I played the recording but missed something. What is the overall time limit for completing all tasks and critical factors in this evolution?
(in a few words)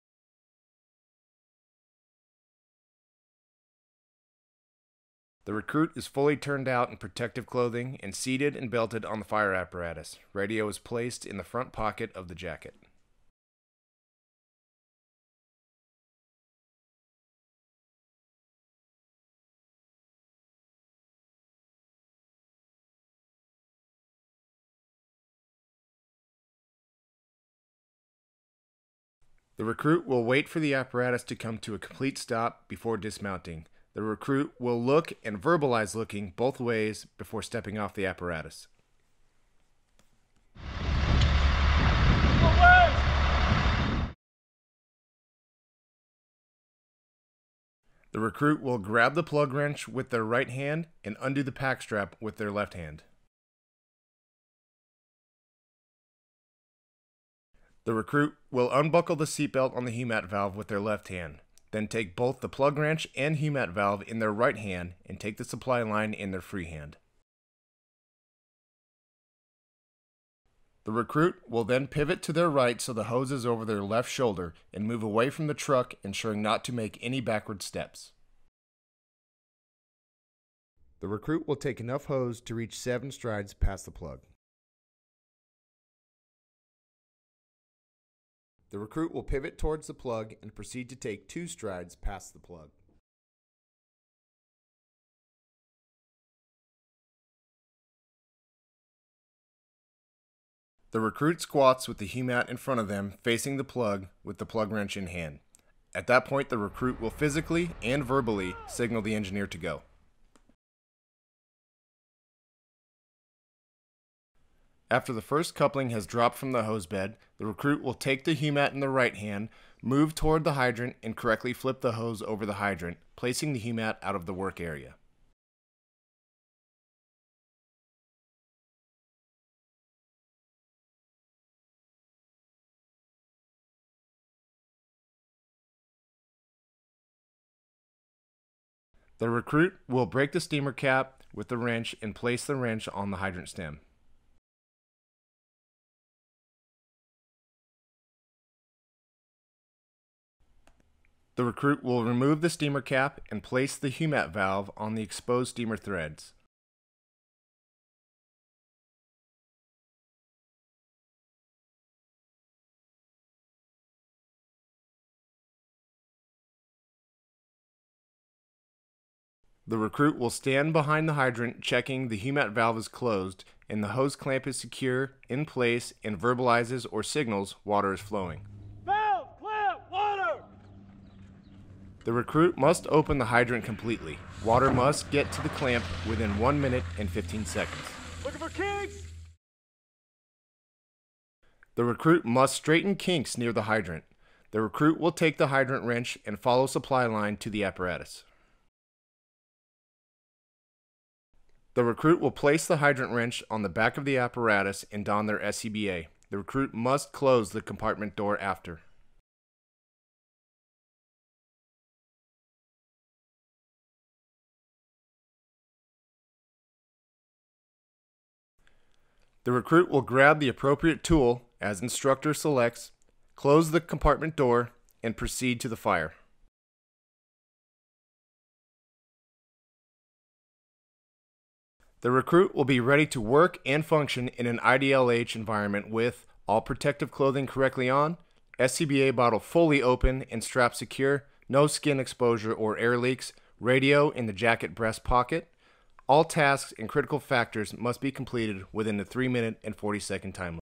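3 minutes 40 seconds.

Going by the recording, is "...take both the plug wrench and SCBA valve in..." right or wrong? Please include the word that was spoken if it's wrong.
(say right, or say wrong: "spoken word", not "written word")
wrong: "HUMAT", not "SCBA".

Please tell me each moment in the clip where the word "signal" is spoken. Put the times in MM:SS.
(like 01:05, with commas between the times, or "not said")
01:48, 02:57.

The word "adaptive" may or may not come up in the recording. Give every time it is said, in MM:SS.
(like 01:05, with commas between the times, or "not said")
not said.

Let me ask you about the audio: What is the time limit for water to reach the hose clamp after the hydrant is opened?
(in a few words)
1 minute 15 seconds.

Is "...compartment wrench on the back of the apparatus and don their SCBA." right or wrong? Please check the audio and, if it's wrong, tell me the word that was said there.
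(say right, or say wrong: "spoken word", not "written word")
wrong: "hydrant", not "compartment".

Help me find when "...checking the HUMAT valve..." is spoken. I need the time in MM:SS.
02:51.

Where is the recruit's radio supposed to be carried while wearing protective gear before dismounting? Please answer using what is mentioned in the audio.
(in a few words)
Front pocket of the jacket.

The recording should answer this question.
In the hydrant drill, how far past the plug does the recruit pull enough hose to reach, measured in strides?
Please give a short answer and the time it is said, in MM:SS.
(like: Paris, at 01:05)
7 strides, at 01:22.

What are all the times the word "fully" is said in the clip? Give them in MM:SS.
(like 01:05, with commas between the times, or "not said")
00:06, 03:59.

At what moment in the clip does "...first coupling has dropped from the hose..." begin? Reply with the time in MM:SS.
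01:55.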